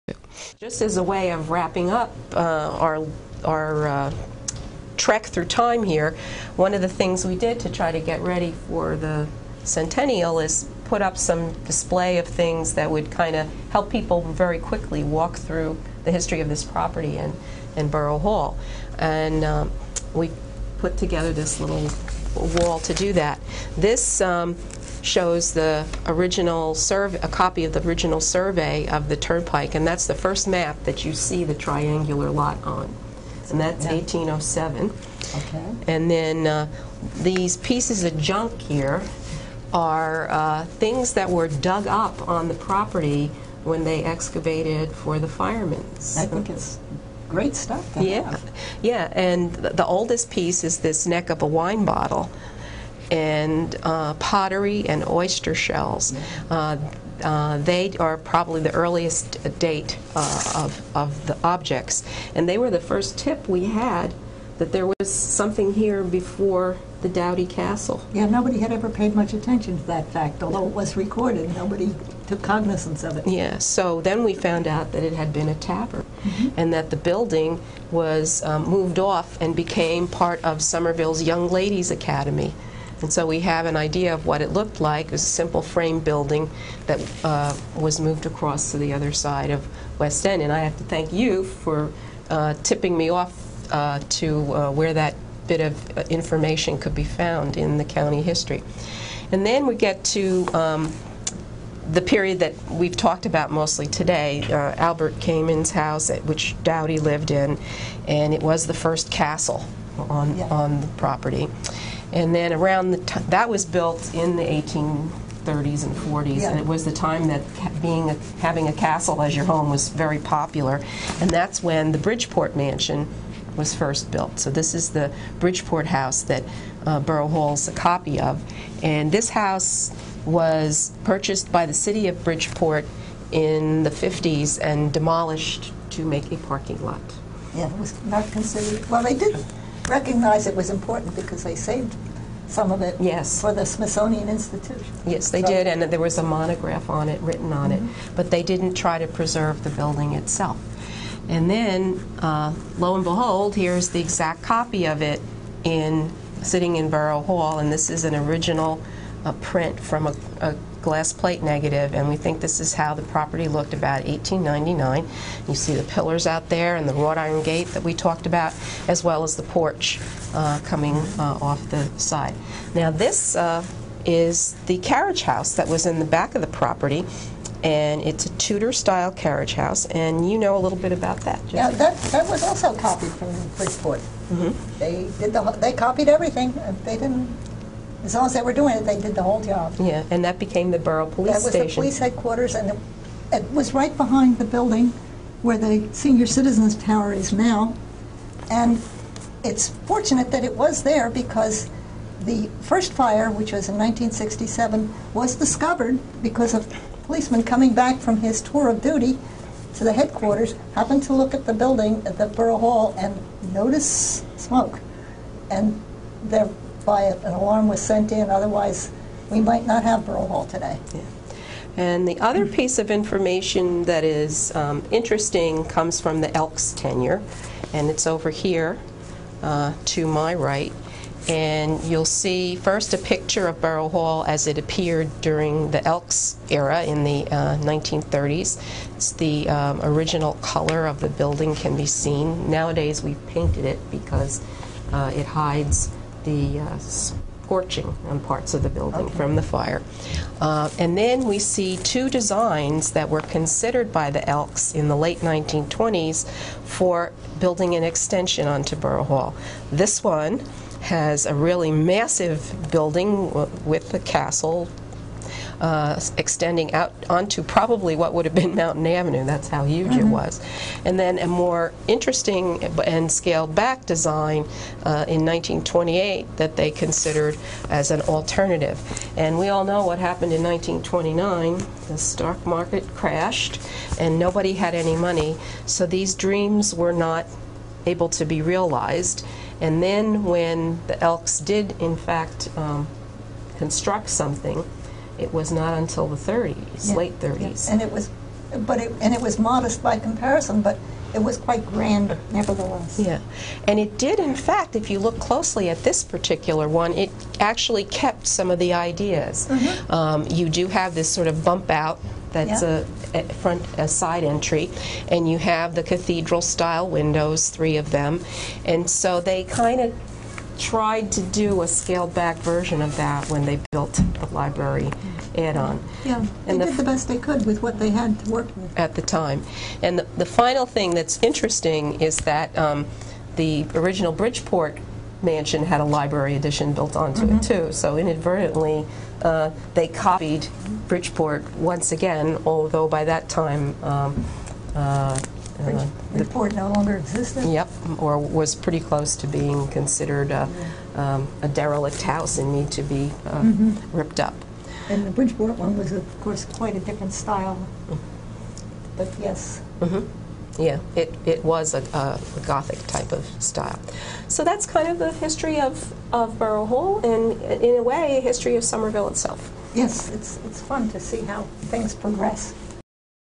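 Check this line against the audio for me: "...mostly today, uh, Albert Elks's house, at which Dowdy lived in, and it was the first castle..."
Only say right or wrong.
wrong.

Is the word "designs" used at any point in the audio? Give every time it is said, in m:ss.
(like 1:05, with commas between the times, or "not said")
4:12, 4:33.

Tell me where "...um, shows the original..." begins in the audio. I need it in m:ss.
0:24.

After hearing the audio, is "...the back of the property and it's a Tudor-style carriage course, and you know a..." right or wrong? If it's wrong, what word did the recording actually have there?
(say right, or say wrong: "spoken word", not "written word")
wrong: "house", not "course".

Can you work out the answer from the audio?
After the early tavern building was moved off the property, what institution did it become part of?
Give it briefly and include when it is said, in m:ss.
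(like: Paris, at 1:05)
Somerville's Young Ladies Academy, at 1:20.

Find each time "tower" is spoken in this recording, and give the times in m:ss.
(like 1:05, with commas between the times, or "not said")
3:16.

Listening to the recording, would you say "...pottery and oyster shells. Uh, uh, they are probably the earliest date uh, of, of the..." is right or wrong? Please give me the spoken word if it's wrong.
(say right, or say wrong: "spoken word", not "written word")
right.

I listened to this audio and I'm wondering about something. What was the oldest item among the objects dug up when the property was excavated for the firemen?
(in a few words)
neck of a wine bottle.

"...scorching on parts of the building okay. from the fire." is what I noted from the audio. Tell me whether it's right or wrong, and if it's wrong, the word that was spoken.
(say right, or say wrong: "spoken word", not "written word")
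right.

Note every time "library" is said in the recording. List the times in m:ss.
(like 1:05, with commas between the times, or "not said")
5:24, 5:35.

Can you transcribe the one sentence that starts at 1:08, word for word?
Yeah, nobody had ever paid much attention to that fact, although it was recorded.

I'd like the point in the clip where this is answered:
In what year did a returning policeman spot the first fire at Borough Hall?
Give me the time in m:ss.
3:23.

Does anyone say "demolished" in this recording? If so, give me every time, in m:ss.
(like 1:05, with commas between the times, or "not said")
2:14.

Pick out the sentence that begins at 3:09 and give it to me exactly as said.
Yeah, and that became the borough police station.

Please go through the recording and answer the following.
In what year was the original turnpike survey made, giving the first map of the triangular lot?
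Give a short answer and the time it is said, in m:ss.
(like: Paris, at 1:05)
1807, at 0:33.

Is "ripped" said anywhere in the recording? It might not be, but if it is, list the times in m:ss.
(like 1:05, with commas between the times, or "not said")
5:53.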